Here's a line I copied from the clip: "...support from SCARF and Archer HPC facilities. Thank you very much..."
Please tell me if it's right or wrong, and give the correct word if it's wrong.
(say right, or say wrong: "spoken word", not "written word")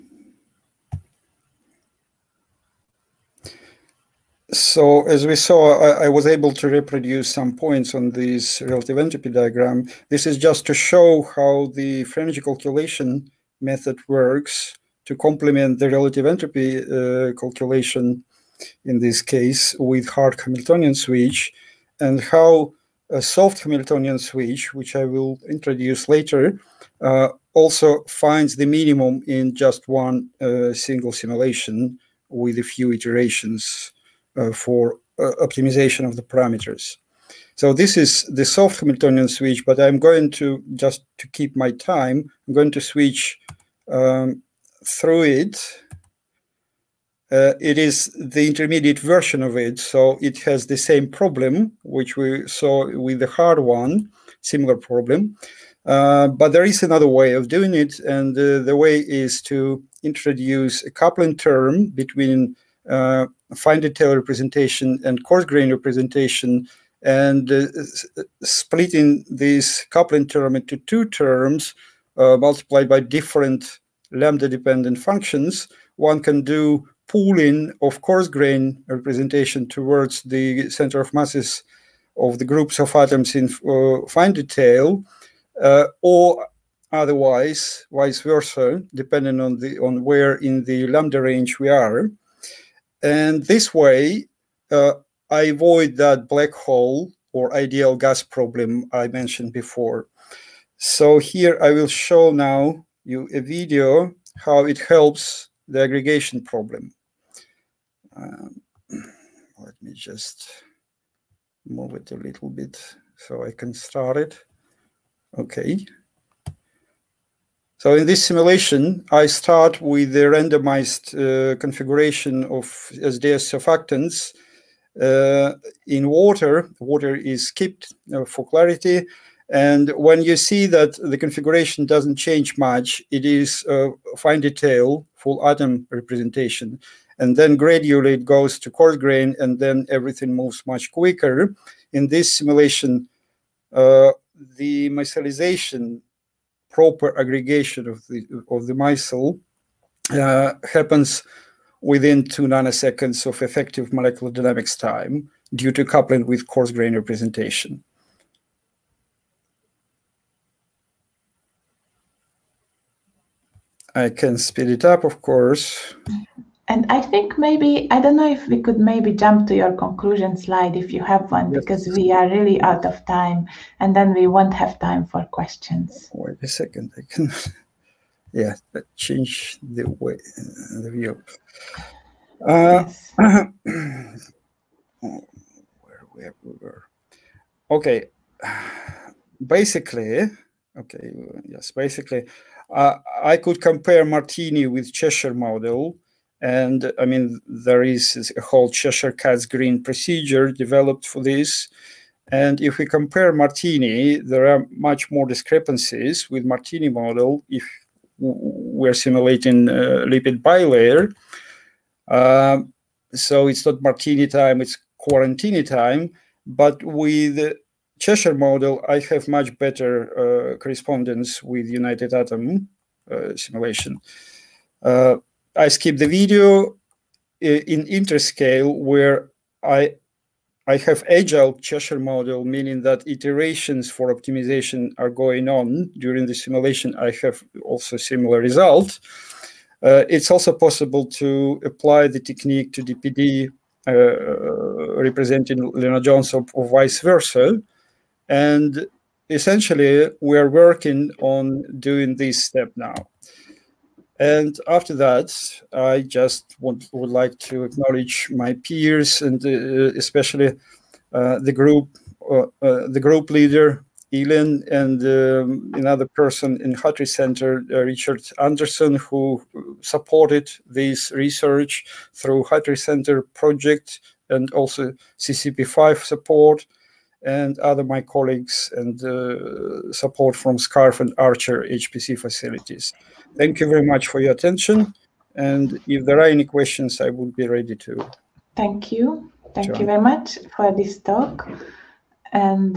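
right.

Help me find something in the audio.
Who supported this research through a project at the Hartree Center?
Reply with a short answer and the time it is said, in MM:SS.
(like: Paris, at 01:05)
Richard Anderson, at 04:27.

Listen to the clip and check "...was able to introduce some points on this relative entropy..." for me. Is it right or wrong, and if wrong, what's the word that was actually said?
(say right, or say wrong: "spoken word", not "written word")
wrong: "reproduce", not "introduce".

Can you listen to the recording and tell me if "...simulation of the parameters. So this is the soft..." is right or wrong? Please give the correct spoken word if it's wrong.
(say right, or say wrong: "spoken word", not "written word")
wrong: "optimization", not "simulation".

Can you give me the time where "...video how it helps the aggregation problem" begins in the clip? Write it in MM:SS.
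01:43.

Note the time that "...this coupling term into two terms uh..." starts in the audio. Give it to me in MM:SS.
01:09.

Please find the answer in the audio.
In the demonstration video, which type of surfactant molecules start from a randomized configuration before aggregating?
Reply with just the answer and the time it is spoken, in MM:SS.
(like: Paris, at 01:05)
SDS, at 02:02.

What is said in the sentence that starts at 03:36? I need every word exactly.
But with Cheshire model, I have much better uh, correspondence with United Atom uh, simulation.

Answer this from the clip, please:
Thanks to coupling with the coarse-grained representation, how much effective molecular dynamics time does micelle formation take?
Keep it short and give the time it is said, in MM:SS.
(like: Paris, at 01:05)
2 nanoseconds, at 02:32.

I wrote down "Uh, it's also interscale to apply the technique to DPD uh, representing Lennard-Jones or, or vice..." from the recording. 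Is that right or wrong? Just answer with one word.
wrong.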